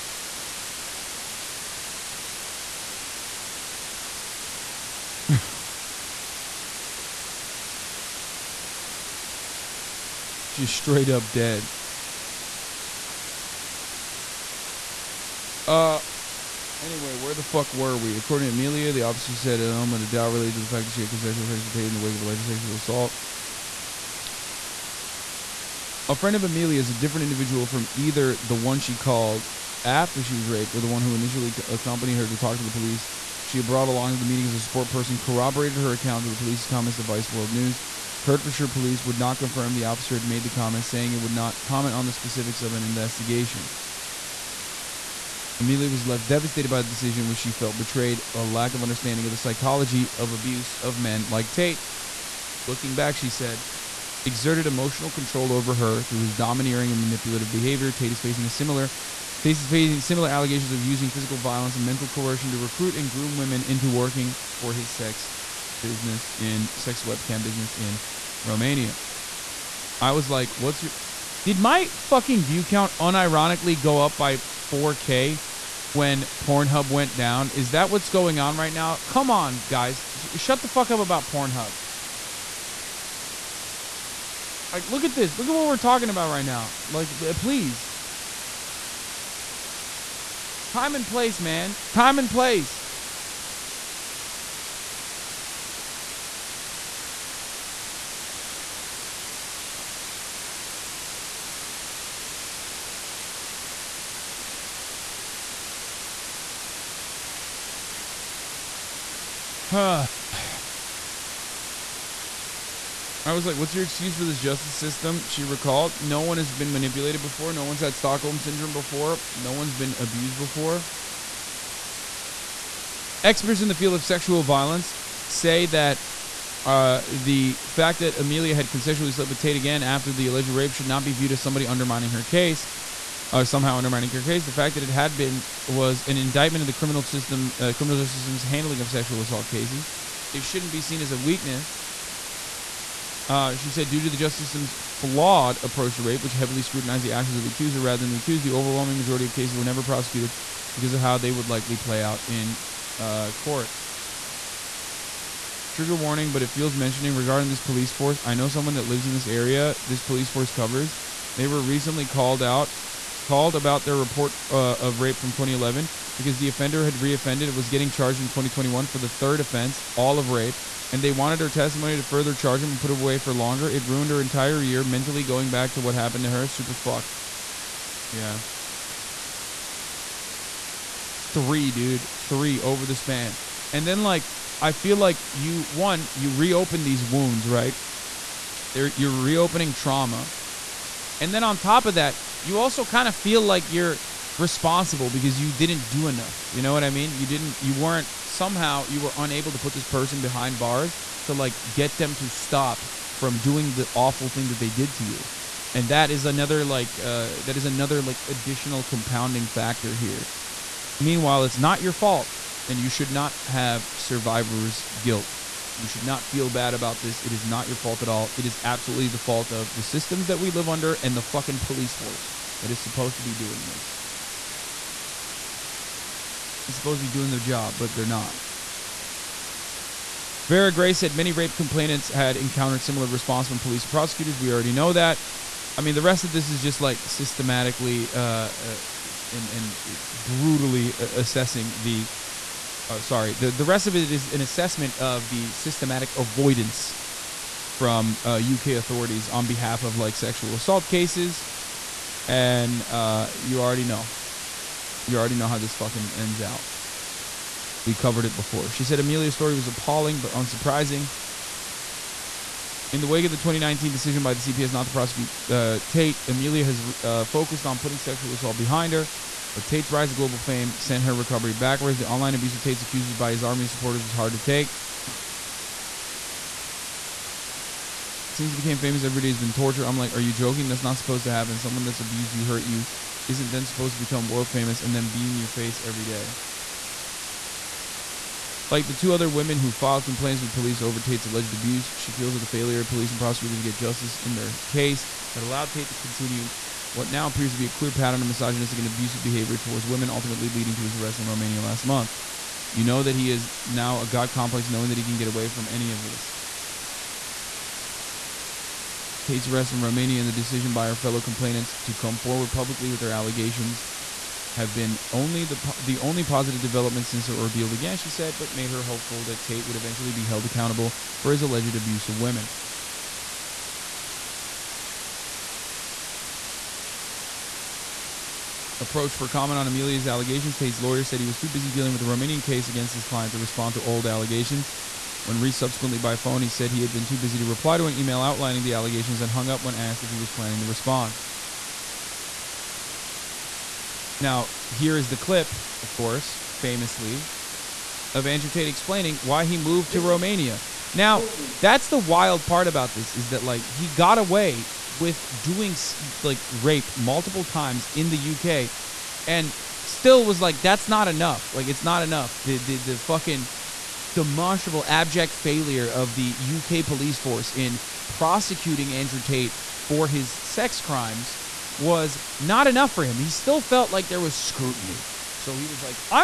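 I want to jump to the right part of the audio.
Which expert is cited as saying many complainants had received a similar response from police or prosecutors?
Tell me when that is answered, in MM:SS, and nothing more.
03:50.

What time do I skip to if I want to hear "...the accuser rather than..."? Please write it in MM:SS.
02:27.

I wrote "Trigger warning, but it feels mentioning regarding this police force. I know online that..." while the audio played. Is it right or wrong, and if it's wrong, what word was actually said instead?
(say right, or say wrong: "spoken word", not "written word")
wrong: "someone", not "online".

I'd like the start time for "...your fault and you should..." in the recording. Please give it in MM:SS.
03:31.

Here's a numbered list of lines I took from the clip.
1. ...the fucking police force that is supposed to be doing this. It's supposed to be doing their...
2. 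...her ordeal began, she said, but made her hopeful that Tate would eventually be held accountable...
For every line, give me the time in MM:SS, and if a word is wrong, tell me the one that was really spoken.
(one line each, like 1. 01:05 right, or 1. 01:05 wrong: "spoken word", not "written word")
1. 03:41 right
2. 05:17 right.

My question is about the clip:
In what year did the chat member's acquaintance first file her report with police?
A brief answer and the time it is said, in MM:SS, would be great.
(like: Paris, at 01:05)
2011, at 02:45.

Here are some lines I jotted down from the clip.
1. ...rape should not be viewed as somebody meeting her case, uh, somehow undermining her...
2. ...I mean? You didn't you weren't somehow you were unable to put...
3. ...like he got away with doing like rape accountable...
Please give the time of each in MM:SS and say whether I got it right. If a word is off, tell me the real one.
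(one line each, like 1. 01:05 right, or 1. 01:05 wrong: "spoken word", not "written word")
1. 02:10 wrong: "undermining", not "meeting"
2. 03:16 right
3. 05:53 wrong: "multiple", not "accountable".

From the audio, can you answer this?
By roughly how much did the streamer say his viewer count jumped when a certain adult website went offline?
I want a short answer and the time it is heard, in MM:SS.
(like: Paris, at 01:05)
4K, at 01:14.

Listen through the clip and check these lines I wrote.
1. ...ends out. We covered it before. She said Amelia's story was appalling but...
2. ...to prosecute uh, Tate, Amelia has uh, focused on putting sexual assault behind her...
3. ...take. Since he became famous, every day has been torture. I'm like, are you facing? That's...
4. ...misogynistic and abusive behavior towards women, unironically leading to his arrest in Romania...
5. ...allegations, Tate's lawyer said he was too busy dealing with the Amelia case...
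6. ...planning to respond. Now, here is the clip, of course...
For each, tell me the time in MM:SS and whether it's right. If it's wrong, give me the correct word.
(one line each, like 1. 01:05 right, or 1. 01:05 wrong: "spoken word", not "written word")
1. 04:16 right
2. 04:24 right
3. 04:34 wrong: "joking", not "facing"
4. 04:58 wrong: "ultimately", not "unironically"
5. 05:30 wrong: "Romanian", not "Amelia"
6. 05:40 right.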